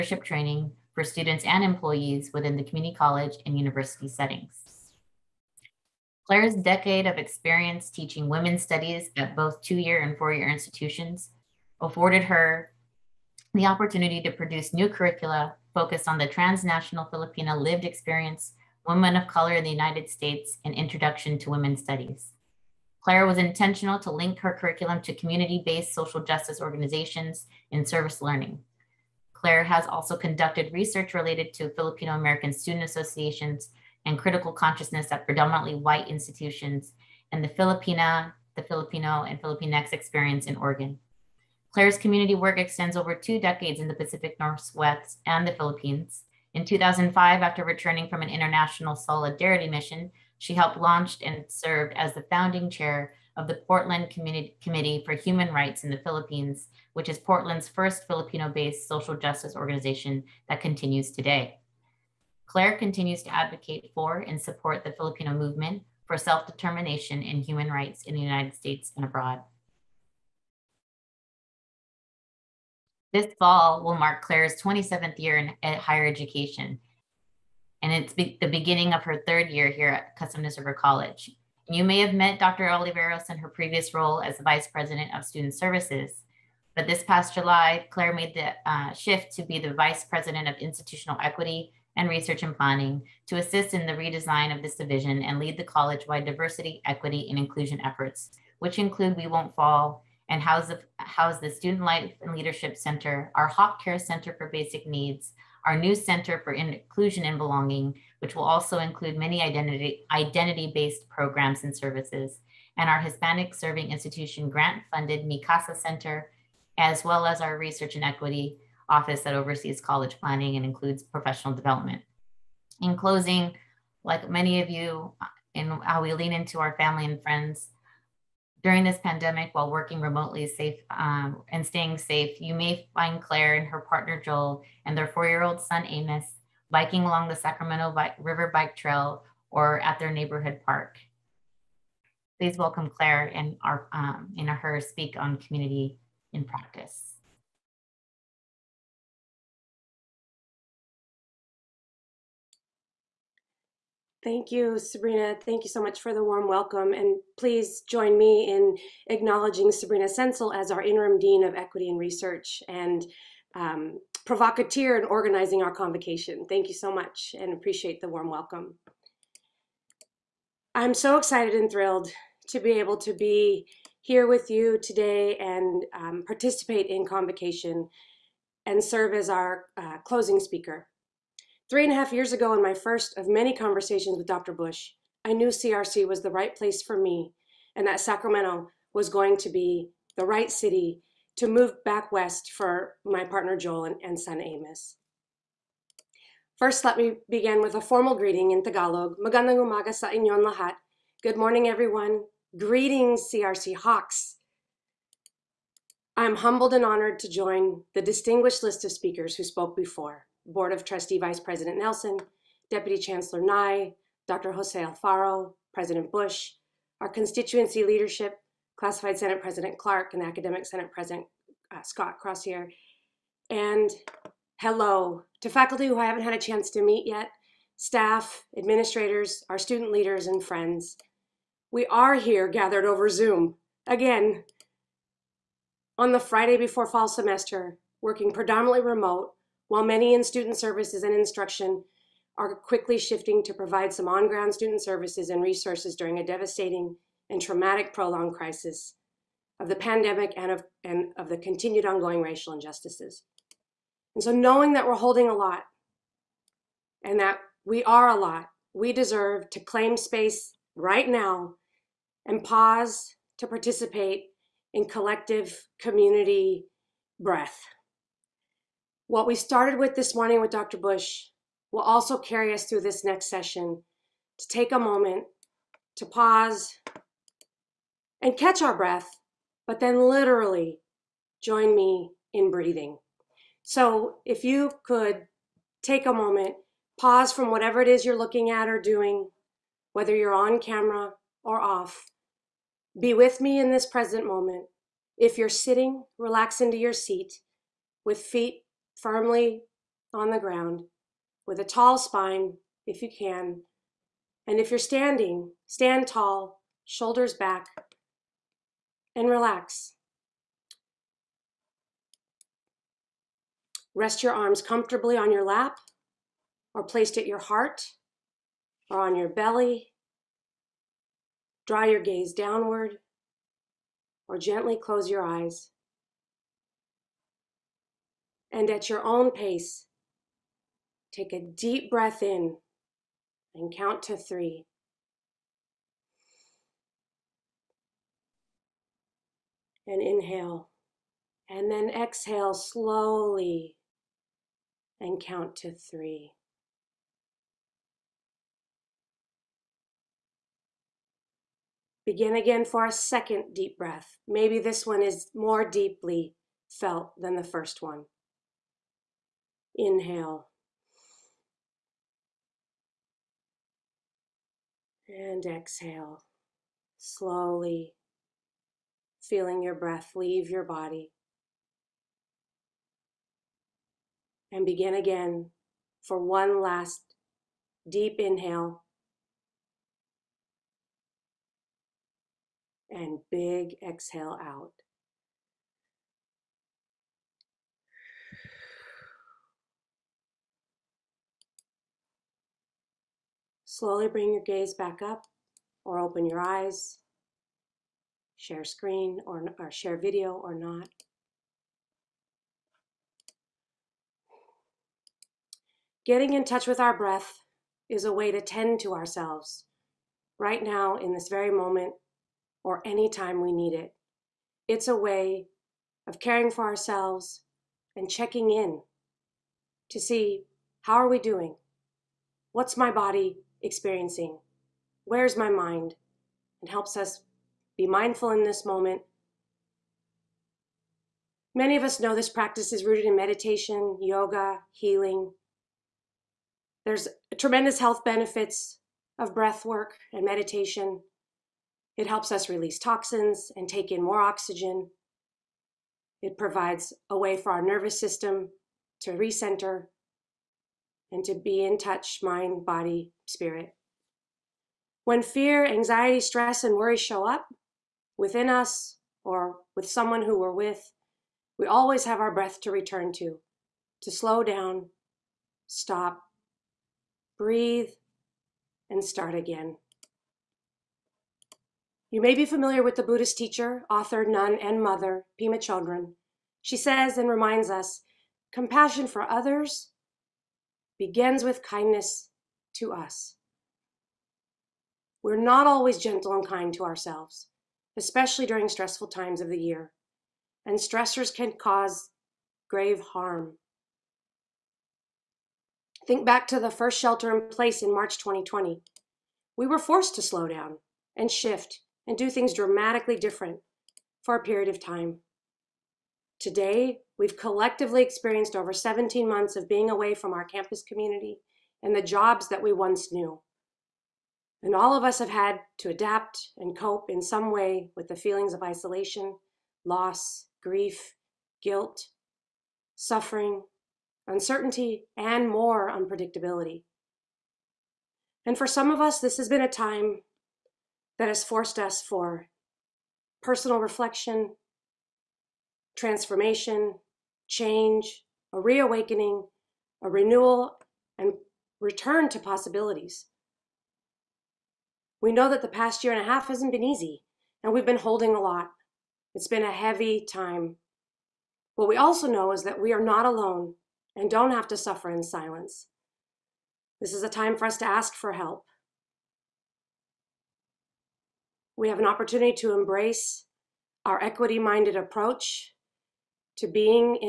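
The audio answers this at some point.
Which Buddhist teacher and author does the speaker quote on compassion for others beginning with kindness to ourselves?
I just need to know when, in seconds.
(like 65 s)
475 s.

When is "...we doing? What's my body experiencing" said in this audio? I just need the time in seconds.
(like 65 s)
421 s.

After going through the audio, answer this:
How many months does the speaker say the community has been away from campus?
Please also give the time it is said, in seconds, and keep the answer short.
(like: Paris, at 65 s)
17, at 508 s.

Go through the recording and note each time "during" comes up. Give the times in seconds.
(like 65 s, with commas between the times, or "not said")
128 s, 245 s, 488 s.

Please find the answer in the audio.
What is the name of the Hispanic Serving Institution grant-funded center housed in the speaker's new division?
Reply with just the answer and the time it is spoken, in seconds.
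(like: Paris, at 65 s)
MICASA Center, at 115 s.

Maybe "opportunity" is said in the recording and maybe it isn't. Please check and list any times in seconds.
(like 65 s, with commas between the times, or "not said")
13 s, 562 s.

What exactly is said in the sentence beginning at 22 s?
Claire was intentional to link her curriculum to community-based social justice organizations in service learning.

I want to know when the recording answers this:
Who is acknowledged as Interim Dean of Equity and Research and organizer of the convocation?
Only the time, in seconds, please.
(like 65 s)
159 s.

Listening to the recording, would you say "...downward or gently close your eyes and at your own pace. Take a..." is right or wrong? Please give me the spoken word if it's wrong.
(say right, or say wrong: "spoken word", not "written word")
right.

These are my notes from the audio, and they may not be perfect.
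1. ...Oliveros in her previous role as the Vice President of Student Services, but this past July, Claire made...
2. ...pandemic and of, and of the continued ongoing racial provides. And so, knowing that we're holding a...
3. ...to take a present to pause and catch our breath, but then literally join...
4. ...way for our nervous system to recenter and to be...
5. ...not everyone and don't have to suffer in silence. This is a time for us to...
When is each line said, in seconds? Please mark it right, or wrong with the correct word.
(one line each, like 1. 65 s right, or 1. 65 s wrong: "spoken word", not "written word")
1. 82 s right
2. 249 s wrong: "injustices", not "provides"
3. 274 s wrong: "moment", not "present"
4. 447 s right
5. 553 s wrong: "alone", not "everyone".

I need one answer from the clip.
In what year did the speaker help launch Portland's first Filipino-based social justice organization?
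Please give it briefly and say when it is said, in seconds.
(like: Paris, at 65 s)
2005, at 46 s.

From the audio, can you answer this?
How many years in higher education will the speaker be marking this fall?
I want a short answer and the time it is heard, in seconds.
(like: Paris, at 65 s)
27, at 74 s.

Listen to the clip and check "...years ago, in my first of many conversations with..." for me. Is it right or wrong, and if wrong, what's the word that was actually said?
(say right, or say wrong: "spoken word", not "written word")
right.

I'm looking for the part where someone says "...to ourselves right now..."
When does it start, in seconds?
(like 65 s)
408 s.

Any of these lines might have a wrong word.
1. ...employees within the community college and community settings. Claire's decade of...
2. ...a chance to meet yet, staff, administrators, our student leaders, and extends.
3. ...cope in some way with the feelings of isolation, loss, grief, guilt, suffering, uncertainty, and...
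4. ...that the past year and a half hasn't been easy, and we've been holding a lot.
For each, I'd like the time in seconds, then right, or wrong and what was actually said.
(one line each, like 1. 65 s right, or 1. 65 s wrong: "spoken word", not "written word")
1. 1 s wrong: "university", not "community"
2. 226 s wrong: "friends", not "extends"
3. 516 s right
4. 545 s right.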